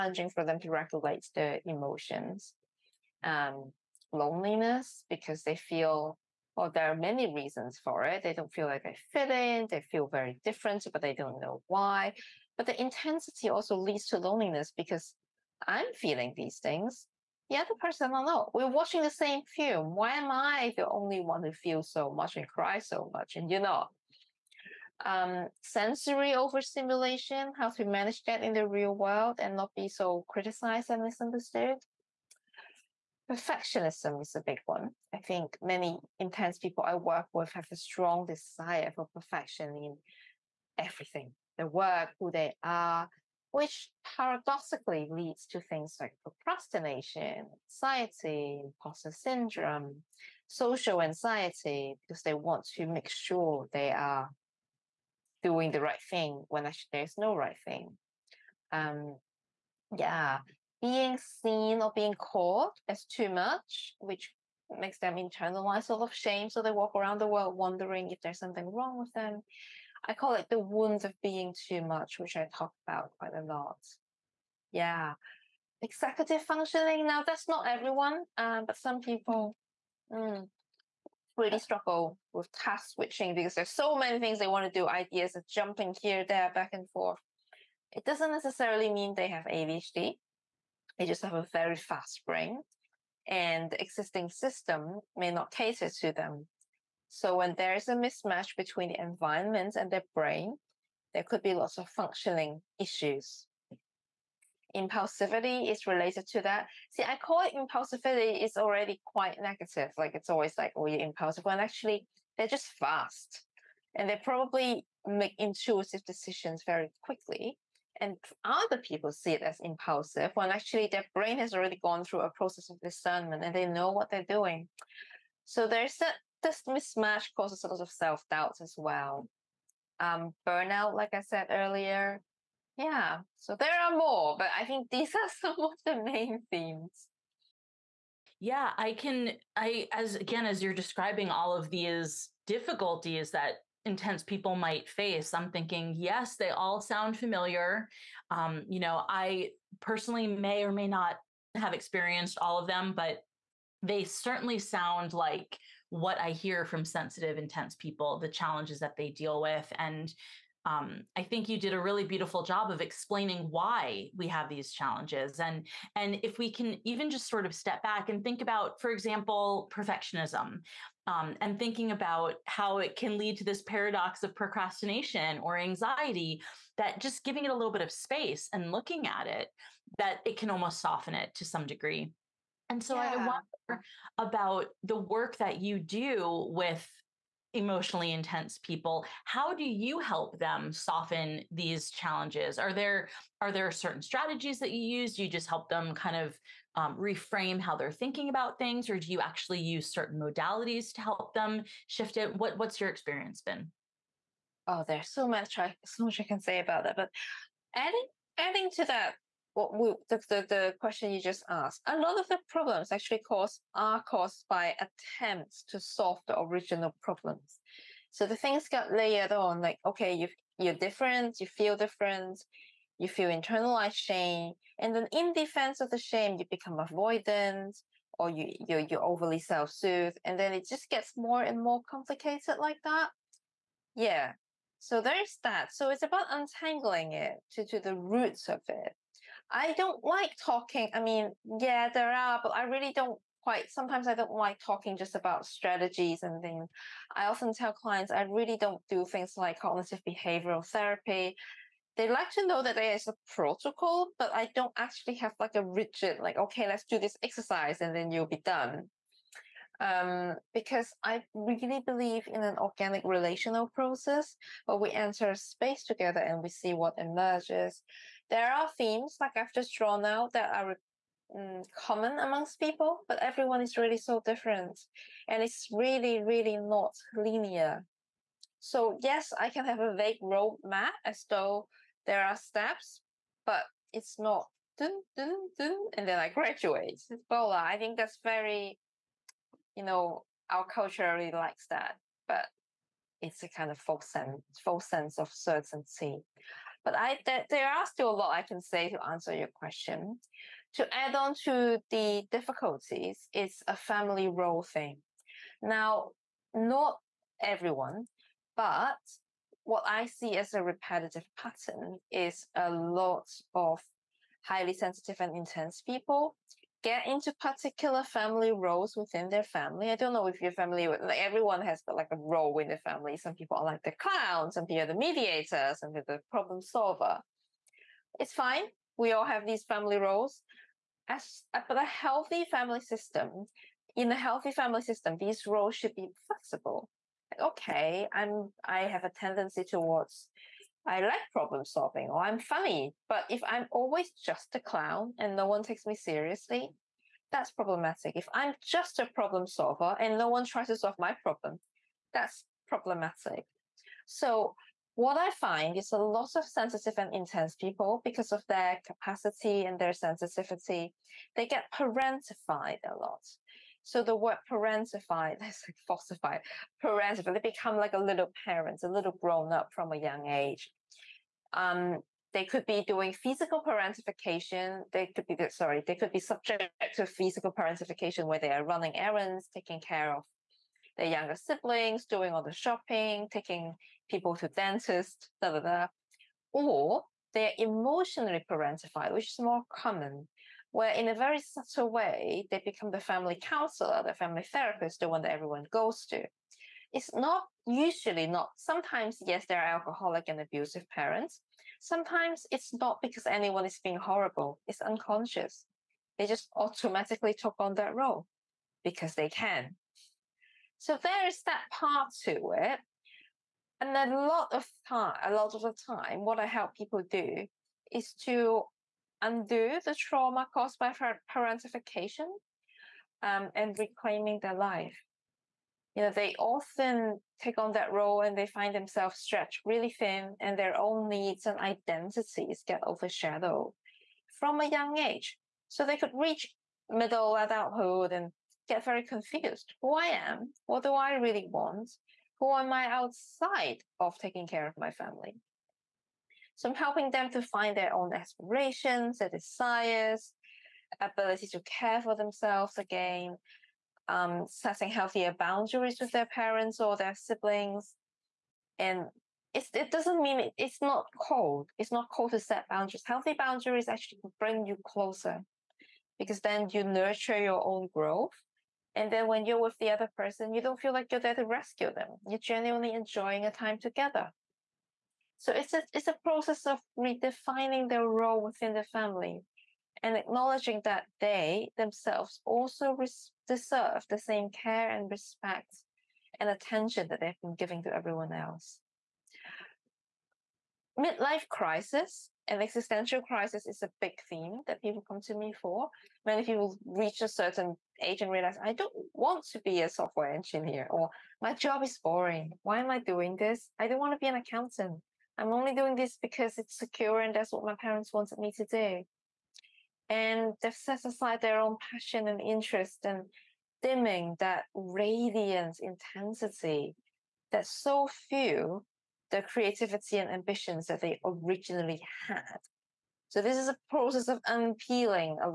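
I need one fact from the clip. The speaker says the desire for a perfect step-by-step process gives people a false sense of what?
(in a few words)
certainty.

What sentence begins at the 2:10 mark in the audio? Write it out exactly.
Um, burnout, like I said earlier.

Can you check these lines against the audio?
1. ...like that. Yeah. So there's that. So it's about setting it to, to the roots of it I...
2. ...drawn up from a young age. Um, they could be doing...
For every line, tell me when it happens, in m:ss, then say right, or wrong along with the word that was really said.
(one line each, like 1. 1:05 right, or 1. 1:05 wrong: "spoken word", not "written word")
1. 3:52 wrong: "untangling", not "setting"
2. 6:09 wrong: "grown", not "drawn".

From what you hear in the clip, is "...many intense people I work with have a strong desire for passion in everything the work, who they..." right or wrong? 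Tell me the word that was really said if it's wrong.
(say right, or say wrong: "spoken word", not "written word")
wrong: "perfection", not "passion".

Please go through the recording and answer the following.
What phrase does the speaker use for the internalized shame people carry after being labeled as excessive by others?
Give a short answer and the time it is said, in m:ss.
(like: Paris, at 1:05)
the wounds of being too much, at 1:10.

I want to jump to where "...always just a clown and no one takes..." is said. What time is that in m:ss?
5:43.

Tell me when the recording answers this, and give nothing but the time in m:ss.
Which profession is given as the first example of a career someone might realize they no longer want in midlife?
8:19.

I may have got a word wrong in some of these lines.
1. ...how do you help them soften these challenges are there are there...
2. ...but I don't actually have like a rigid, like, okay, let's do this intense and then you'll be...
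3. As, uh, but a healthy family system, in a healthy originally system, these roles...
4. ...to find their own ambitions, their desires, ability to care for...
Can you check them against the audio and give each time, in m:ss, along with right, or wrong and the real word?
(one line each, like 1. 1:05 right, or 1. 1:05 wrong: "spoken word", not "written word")
1. 3:09 right
2. 4:14 wrong: "exercise", not "intense"
3. 5:31 wrong: "family", not "originally"
4. 7:27 wrong: "aspirations", not "ambitions".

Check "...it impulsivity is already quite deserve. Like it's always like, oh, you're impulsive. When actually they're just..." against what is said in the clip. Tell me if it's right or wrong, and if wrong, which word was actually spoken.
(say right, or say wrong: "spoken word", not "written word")
wrong: "negative", not "deserve".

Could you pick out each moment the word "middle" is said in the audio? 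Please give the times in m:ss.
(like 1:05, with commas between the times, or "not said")
7:16.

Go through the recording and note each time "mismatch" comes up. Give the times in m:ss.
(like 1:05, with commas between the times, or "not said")
1:37, 2:06.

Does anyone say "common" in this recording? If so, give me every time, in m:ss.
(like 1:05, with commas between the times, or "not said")
4:31, 6:29.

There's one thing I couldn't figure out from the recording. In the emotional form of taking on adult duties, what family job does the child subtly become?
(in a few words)
family counselor.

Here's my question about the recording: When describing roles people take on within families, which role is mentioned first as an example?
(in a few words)
the clown.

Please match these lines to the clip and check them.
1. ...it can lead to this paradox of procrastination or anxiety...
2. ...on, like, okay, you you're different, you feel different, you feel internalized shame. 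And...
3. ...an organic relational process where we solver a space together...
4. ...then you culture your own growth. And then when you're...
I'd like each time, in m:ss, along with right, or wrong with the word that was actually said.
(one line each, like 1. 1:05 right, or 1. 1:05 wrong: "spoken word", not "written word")
1. 2:52 right
2. 3:39 right
3. 4:22 wrong: "enter", not "solver"
4. 7:46 wrong: "nurture", not "culture".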